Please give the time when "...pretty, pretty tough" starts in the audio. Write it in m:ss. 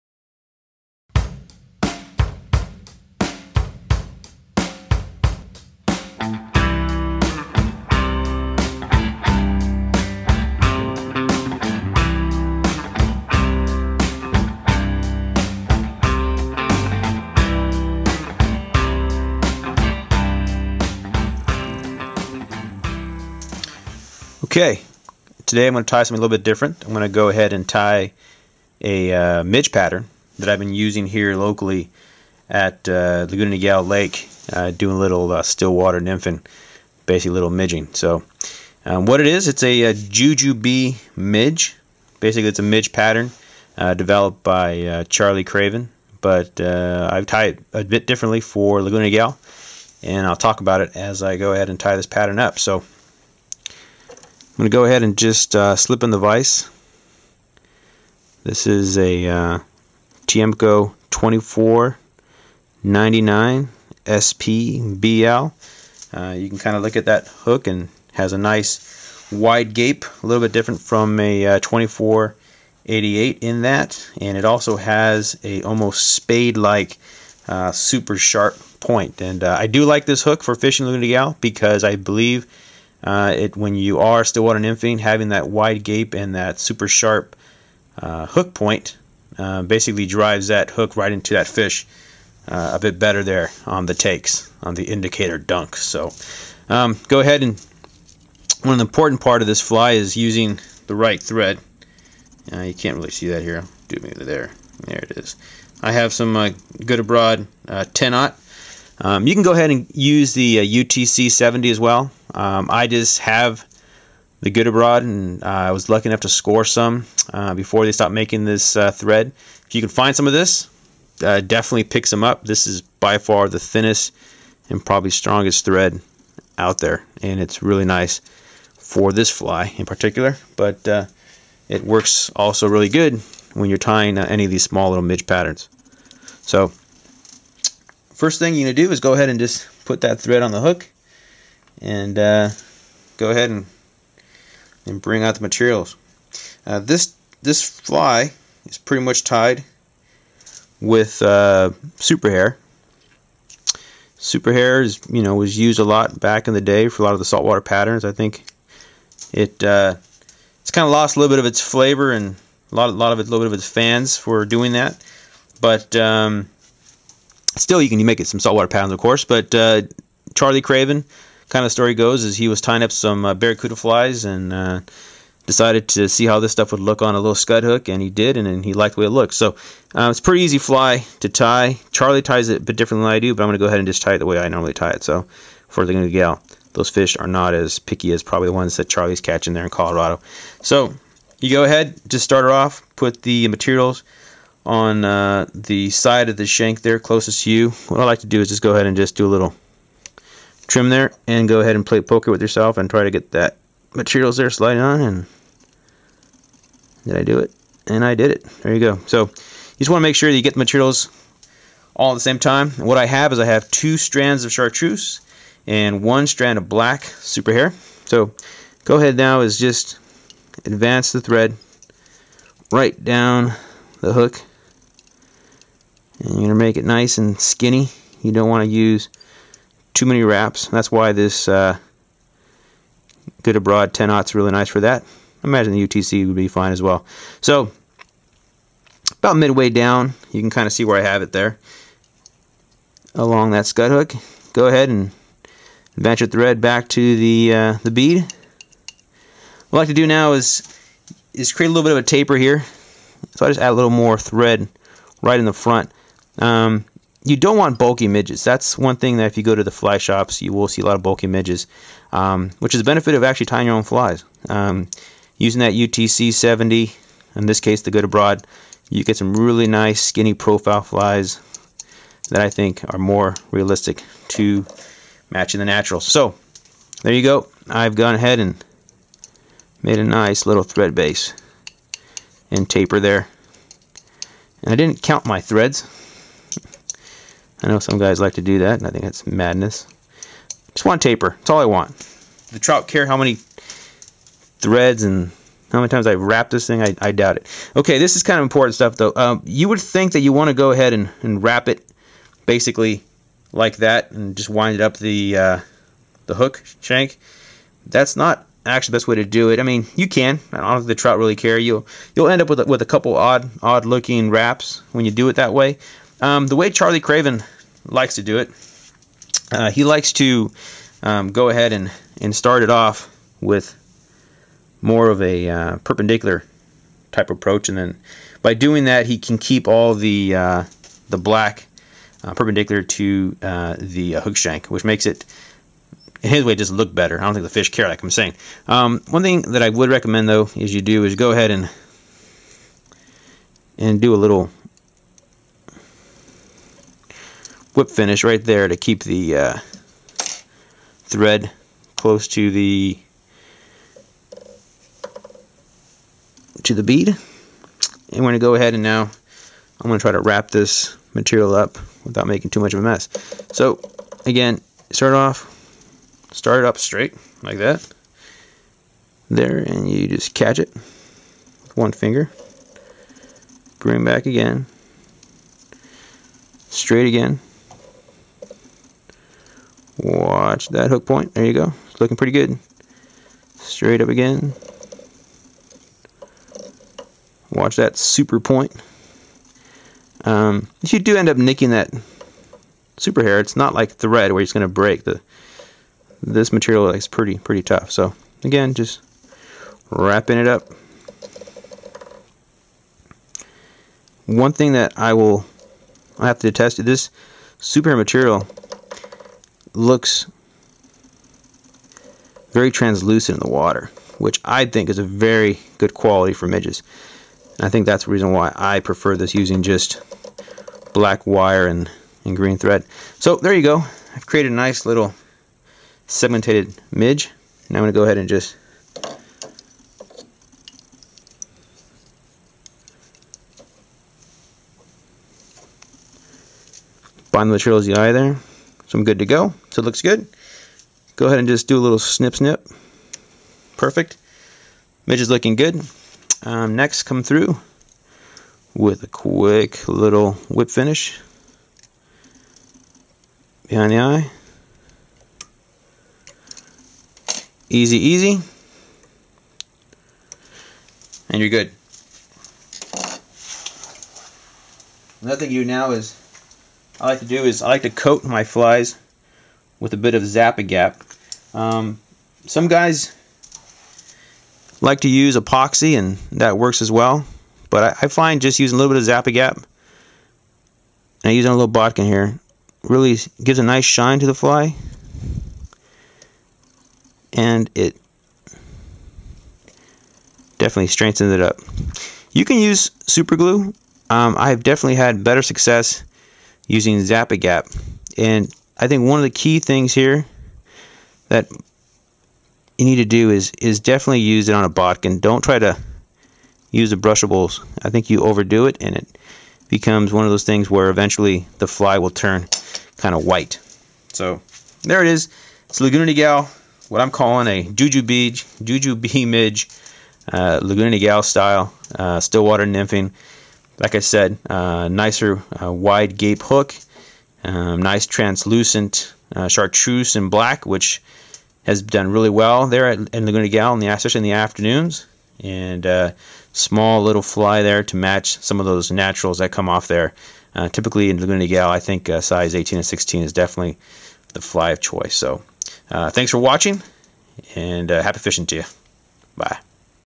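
6:37.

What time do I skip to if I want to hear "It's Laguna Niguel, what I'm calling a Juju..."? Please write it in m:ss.
8:35.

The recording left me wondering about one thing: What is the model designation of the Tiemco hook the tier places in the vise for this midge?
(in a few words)
2499 SPBL.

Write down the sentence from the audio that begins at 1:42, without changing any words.
Uh, you can't really see that here.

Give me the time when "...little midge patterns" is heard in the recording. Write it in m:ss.
2:14.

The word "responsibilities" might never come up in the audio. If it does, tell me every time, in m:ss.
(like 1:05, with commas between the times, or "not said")
not said.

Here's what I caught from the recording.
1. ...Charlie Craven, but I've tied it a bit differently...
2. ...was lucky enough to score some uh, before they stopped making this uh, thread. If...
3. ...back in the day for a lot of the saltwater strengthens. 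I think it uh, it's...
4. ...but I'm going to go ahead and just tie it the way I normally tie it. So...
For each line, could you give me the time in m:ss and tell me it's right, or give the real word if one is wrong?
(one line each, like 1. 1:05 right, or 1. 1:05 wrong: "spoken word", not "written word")
1. 0:45 right
2. 1:55 right
3. 2:36 wrong: "patterns", not "strengthens"
4. 3:03 right.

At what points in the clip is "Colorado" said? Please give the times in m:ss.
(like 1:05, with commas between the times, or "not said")
3:09.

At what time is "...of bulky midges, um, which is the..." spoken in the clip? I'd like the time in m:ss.
4:20.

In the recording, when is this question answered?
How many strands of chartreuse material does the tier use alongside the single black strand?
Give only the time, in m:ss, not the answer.
3:33.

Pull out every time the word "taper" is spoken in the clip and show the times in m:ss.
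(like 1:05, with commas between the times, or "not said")
4:12, 4:42, 4:50.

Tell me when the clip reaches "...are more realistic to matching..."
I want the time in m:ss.
4:32.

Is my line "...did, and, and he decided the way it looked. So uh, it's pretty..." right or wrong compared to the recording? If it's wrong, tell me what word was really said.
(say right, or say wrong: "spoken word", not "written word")
wrong: "liked", not "decided".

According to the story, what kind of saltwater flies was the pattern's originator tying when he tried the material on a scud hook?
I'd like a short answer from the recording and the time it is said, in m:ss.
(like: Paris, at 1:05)
barracuda flies, at 2:53.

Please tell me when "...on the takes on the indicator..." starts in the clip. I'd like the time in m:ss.
1:33.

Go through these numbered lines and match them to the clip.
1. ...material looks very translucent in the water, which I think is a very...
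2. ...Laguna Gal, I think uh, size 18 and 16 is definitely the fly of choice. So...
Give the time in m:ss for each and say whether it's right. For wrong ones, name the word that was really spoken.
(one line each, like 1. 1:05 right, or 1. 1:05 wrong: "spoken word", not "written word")
1. 6:47 right
2. 9:01 right.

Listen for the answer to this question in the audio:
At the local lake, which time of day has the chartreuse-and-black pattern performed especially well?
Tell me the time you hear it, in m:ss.
8:54.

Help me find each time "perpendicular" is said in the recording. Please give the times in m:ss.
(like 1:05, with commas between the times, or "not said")
5:25, 5:32.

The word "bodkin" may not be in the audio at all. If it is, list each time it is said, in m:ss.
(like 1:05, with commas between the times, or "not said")
8:01, 8:24.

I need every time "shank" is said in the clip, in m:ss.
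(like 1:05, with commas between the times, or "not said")
3:16, 5:06, 5:34.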